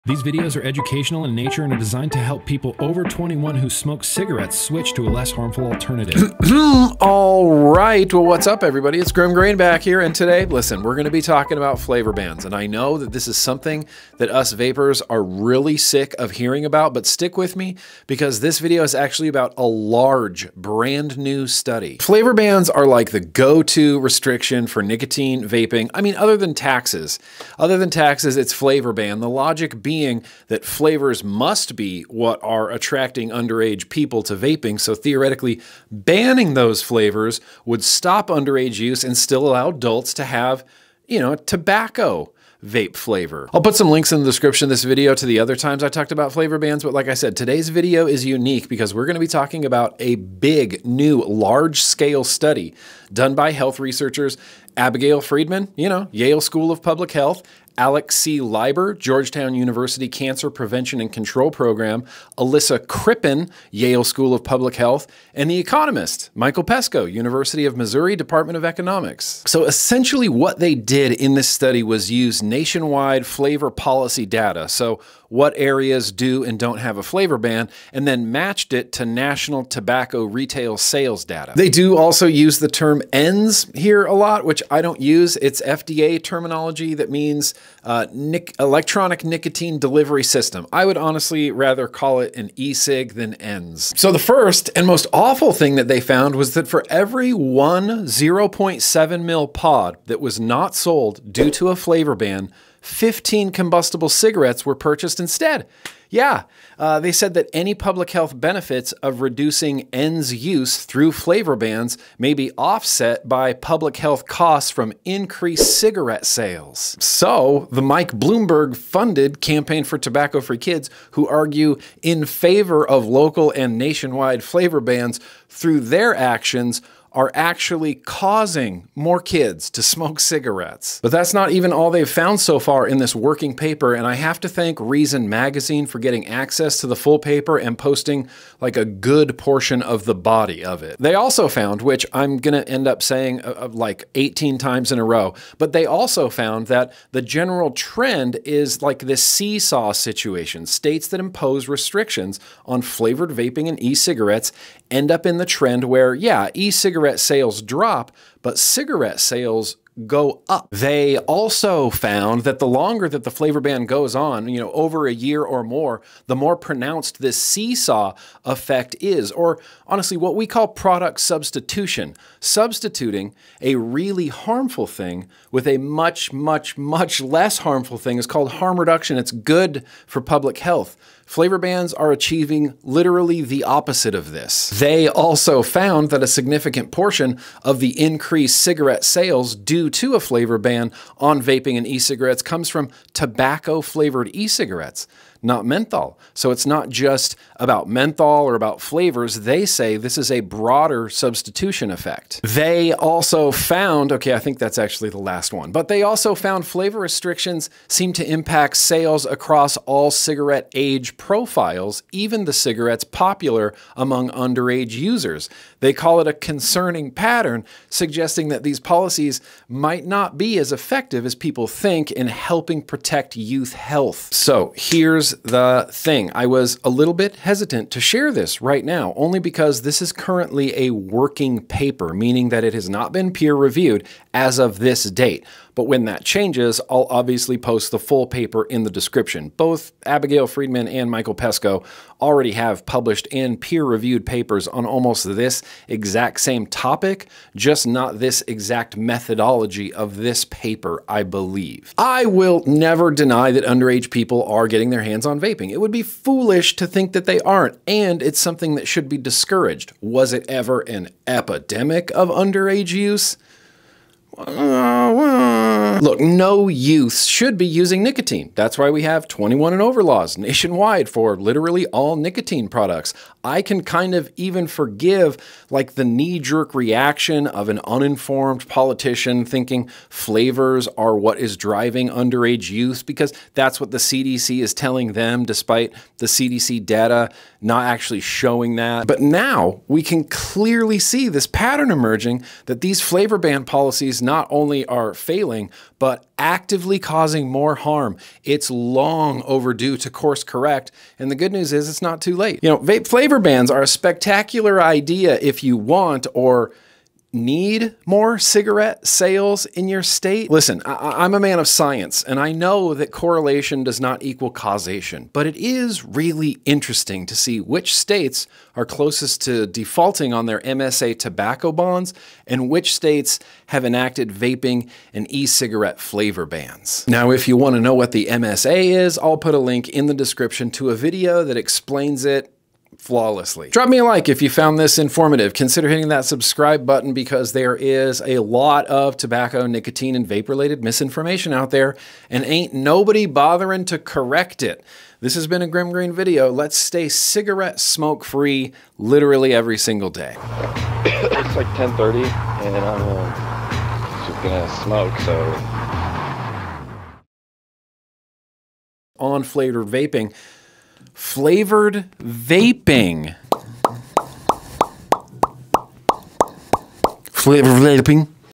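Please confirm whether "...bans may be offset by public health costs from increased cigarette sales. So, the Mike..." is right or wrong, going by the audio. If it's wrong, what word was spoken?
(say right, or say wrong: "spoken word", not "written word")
right.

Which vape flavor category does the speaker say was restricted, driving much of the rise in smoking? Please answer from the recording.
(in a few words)
tobacco flavored.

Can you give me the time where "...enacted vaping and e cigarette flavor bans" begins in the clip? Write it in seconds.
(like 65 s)
323 s.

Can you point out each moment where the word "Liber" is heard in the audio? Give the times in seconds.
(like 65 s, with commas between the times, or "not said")
58 s.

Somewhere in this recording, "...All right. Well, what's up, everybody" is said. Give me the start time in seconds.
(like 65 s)
6 s.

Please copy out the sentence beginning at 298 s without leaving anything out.
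It's long overdue to course correct, and the good news is it's not too late.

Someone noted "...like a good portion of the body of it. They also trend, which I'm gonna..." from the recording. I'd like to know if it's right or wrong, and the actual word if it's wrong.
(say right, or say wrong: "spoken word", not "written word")
wrong: "found", not "trend".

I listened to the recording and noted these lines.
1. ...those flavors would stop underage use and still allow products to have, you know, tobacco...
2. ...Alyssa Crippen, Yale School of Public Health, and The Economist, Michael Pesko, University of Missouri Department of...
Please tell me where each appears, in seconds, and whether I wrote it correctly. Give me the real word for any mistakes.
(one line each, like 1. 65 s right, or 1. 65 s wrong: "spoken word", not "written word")
1. 36 s wrong: "adults", not "products"
2. 62 s right.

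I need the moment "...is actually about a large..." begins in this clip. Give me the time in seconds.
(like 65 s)
18 s.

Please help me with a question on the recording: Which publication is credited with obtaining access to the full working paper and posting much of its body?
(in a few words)
Reason Magazine.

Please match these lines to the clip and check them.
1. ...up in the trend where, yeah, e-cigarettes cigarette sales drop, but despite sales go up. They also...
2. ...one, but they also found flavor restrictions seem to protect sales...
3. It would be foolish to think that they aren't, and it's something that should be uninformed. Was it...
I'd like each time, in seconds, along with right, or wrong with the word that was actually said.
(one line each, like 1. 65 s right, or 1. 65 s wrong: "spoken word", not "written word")
1. 155 s wrong: "cigarette", not "despite"
2. 205 s wrong: "impact", not "protect"
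3. 255 s wrong: "discouraged", not "uninformed".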